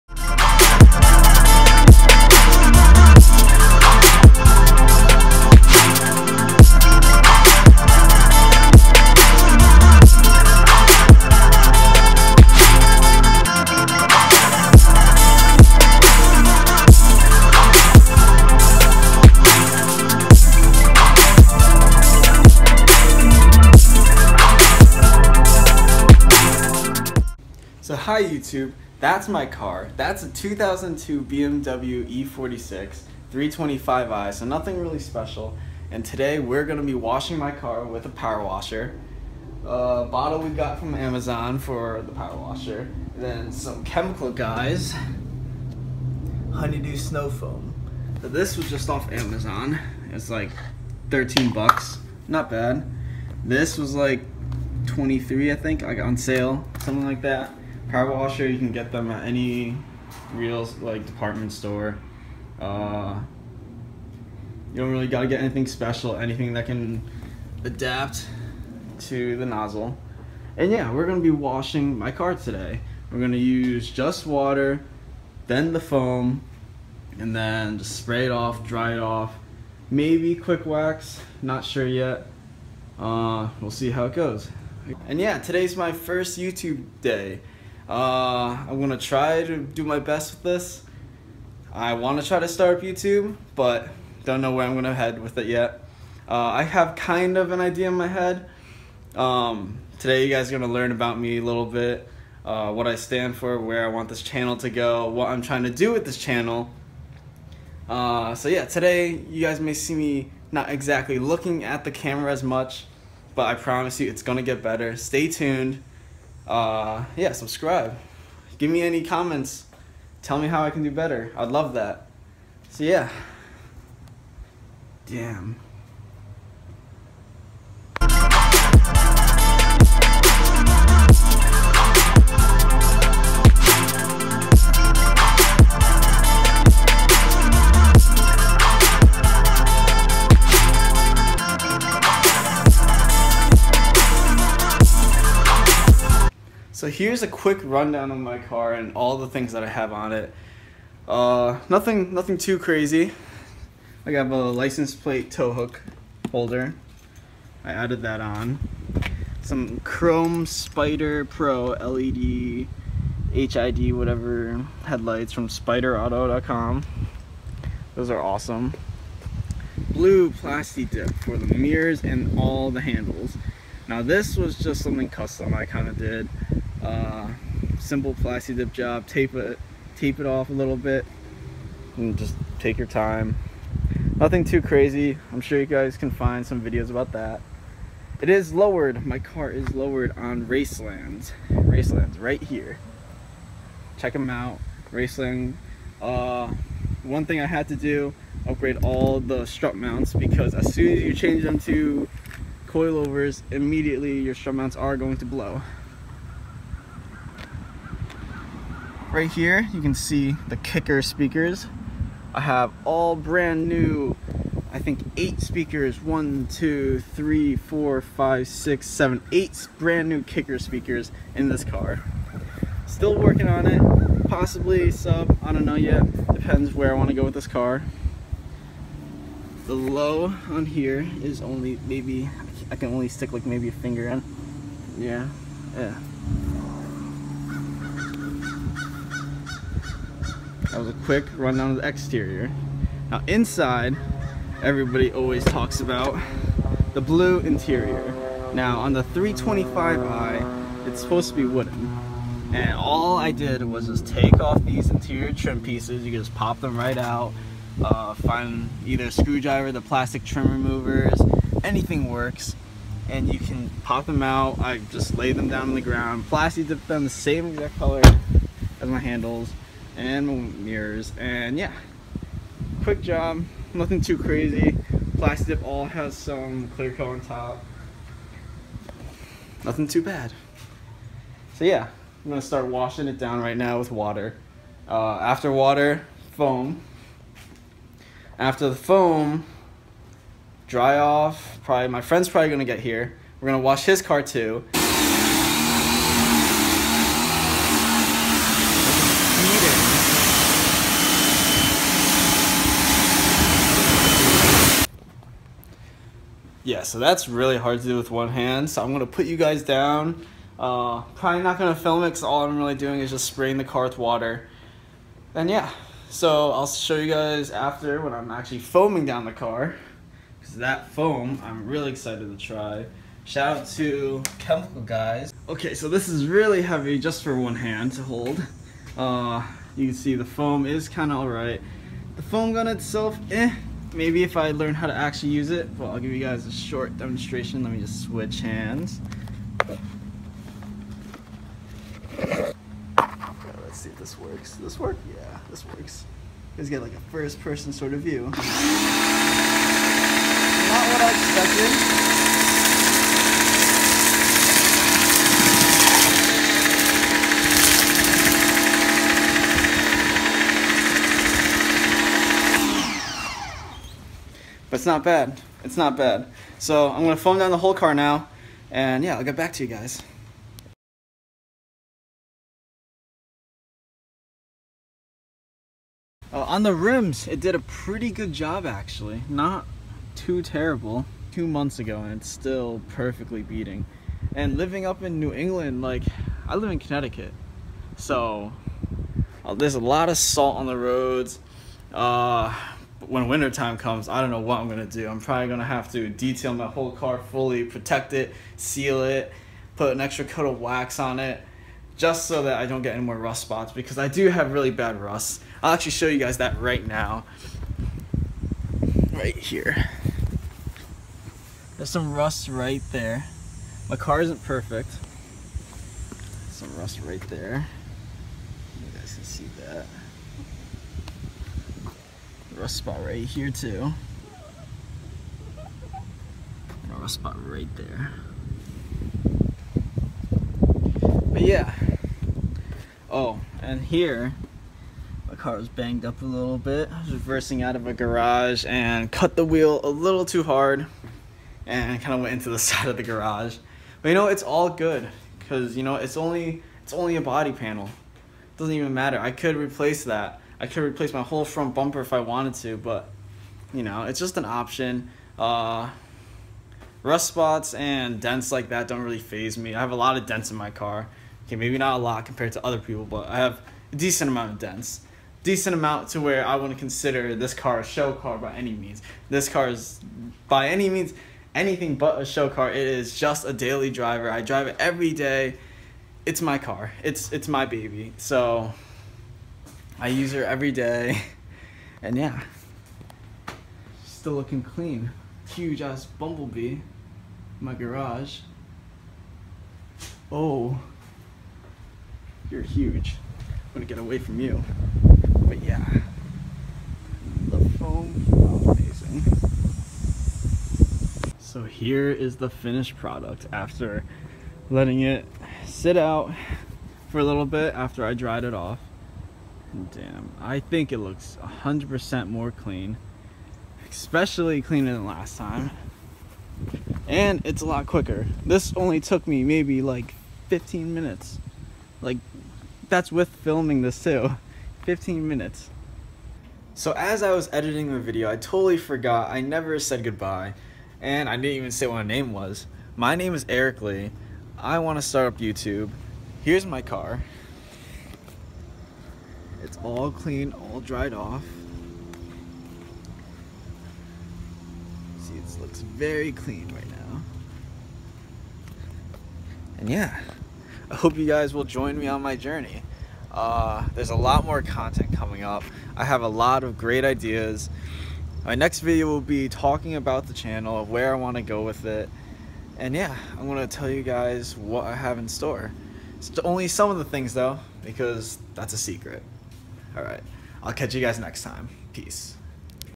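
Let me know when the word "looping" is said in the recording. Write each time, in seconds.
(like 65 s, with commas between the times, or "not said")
not said.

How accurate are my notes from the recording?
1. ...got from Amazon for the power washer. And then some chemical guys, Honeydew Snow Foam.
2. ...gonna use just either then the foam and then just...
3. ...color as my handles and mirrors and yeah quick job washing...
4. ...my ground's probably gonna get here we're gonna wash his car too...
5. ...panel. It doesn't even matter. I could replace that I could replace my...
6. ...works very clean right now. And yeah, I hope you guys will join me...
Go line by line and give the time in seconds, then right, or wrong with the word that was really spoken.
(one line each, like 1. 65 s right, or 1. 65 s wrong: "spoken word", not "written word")
1. 40 s right
2. 73 s wrong: "water", not "either"
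3. 267 s wrong: "nothing", not "washing"
4. 291 s wrong: "friend", not "ground"
5. 447 s right
6. 545 s wrong: "looks", not "works".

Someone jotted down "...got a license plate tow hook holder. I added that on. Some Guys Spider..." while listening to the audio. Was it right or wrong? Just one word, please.
wrong.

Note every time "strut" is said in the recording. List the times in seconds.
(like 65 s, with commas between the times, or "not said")
199 s, 204 s.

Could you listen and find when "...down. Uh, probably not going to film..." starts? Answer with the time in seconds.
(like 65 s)
309 s.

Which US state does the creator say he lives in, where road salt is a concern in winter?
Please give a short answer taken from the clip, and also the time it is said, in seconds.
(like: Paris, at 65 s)
Connecticut, at 386 s.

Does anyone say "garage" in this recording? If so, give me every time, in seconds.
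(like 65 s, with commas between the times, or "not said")
437 s, 443 s, 487 s.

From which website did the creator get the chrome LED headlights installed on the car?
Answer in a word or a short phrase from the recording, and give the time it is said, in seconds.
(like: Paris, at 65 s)
SpiderAuto.com, at 165 s.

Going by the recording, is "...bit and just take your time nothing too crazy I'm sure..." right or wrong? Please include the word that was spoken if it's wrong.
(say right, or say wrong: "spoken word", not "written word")
right.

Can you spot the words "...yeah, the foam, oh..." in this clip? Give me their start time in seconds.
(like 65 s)
495 s.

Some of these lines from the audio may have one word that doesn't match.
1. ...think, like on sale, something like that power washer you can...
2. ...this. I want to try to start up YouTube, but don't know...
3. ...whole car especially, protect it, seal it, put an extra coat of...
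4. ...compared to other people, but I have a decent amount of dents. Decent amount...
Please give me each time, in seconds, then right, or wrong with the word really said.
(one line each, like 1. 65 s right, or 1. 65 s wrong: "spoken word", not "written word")
1. 55 s right
2. 90 s right
3. 396 s wrong: "fully", not "especially"
4. 462 s right.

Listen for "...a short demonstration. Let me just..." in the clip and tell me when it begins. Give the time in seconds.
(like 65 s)
336 s.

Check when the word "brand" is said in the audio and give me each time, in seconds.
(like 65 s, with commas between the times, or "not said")
213 s, 219 s.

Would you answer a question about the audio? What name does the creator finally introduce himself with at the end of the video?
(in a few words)
Eric Lee.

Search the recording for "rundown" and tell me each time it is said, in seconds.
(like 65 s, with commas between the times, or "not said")
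147 s, 241 s.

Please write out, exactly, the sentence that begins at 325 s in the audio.
Okay, so this is really heavy just for one hand to hold.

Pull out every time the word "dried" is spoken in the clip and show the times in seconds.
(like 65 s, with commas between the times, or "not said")
508 s, 540 s.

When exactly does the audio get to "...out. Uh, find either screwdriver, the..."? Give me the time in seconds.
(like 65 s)
256 s.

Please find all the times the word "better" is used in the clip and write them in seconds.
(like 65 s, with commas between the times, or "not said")
114 s, 120 s.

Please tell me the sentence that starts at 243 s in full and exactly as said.
Now inside, everybody always talks about the blue interior.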